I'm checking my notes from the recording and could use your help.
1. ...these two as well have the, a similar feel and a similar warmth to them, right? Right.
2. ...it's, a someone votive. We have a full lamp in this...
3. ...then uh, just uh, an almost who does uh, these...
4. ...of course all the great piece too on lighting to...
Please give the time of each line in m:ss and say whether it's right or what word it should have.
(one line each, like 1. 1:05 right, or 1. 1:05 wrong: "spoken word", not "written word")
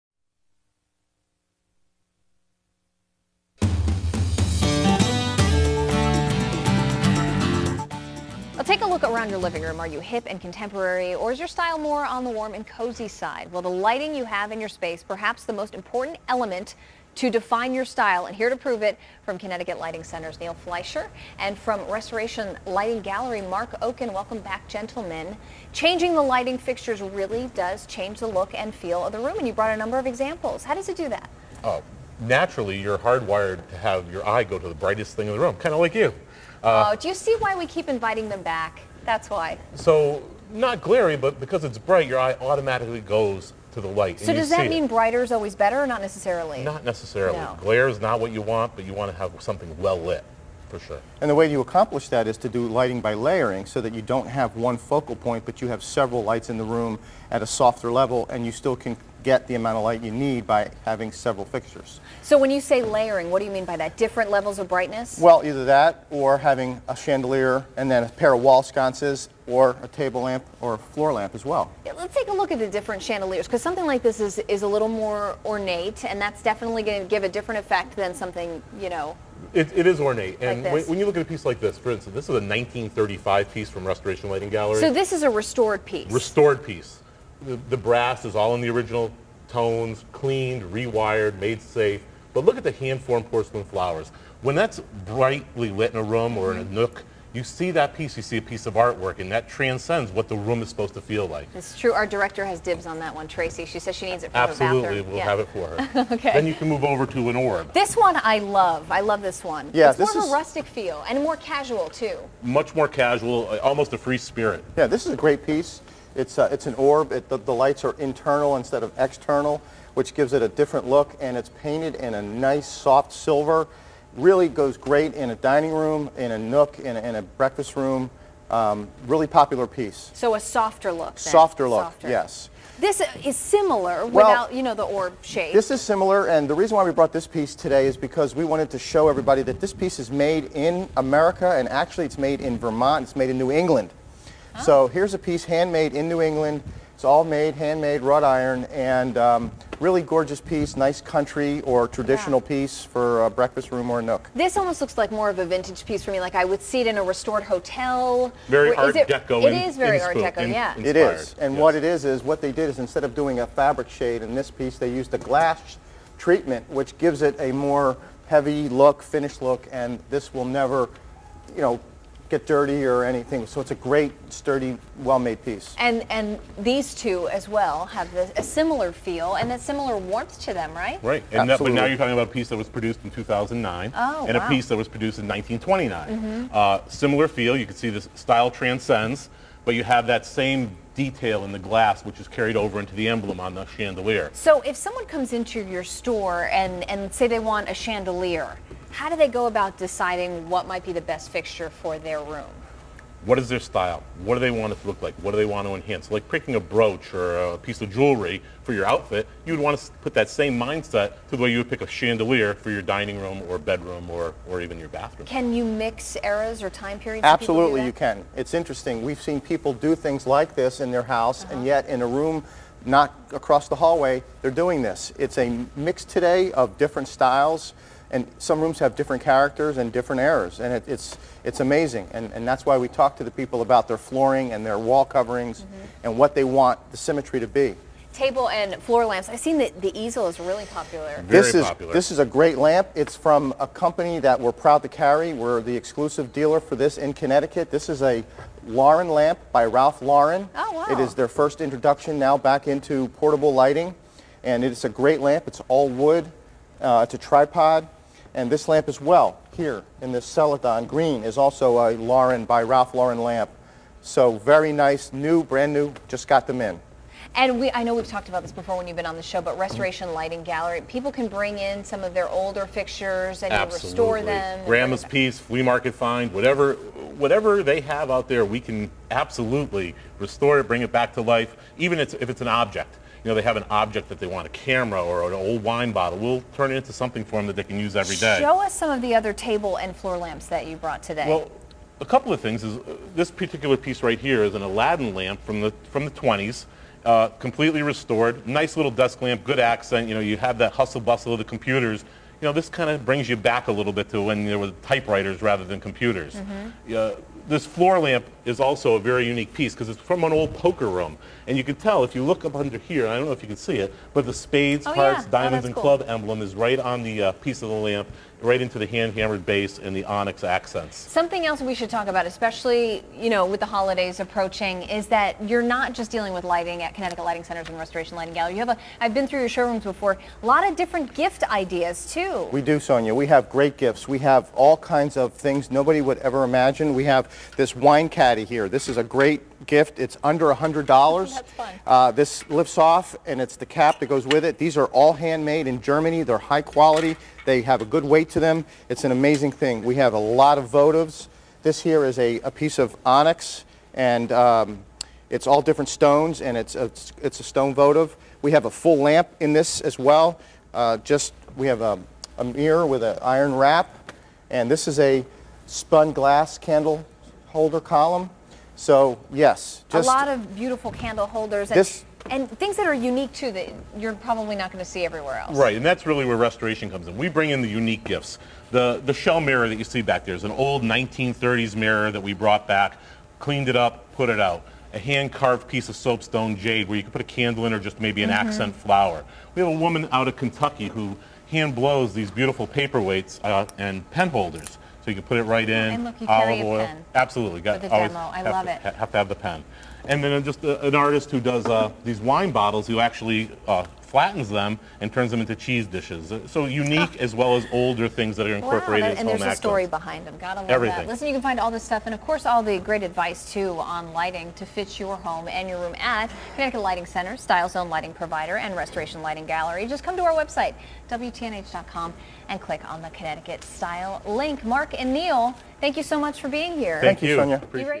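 1. 2:56 right
2. 5:57 wrong: "stone", not "someone"
3. 6:40 wrong: "artist", not "almost"
4. 6:52 wrong: "advice", not "piece".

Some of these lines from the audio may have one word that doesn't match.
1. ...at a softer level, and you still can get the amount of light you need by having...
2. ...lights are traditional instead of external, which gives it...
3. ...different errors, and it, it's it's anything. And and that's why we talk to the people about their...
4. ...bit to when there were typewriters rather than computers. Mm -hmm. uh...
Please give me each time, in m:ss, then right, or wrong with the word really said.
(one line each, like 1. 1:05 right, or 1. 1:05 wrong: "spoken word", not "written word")
1. 0:57 right
2. 1:57 wrong: "internal", not "traditional"
3. 3:49 wrong: "amazing", not "anything"
4. 5:03 right.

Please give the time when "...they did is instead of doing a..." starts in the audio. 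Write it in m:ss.
2:42.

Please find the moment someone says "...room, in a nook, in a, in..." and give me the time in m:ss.
2:05.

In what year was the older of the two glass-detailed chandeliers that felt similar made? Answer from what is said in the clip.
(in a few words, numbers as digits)
1929.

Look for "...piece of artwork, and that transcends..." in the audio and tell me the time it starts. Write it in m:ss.
1:38.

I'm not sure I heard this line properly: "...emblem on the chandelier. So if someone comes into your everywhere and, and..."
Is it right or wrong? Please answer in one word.
wrong.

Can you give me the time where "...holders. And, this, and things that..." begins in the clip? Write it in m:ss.
6:11.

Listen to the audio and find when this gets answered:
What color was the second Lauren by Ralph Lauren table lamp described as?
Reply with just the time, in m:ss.
4:20.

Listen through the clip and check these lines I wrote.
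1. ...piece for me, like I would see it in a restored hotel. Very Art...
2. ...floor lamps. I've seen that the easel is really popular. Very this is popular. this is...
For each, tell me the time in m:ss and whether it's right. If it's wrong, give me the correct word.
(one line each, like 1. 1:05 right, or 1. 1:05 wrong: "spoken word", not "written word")
1. 2:35 right
2. 3:58 right.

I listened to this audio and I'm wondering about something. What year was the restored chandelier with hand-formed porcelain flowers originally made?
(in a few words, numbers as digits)
1935.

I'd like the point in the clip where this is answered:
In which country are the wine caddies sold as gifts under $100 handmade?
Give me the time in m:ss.
5:45.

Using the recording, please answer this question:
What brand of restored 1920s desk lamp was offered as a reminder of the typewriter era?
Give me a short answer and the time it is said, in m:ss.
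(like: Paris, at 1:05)
Aladdin, at 4:54.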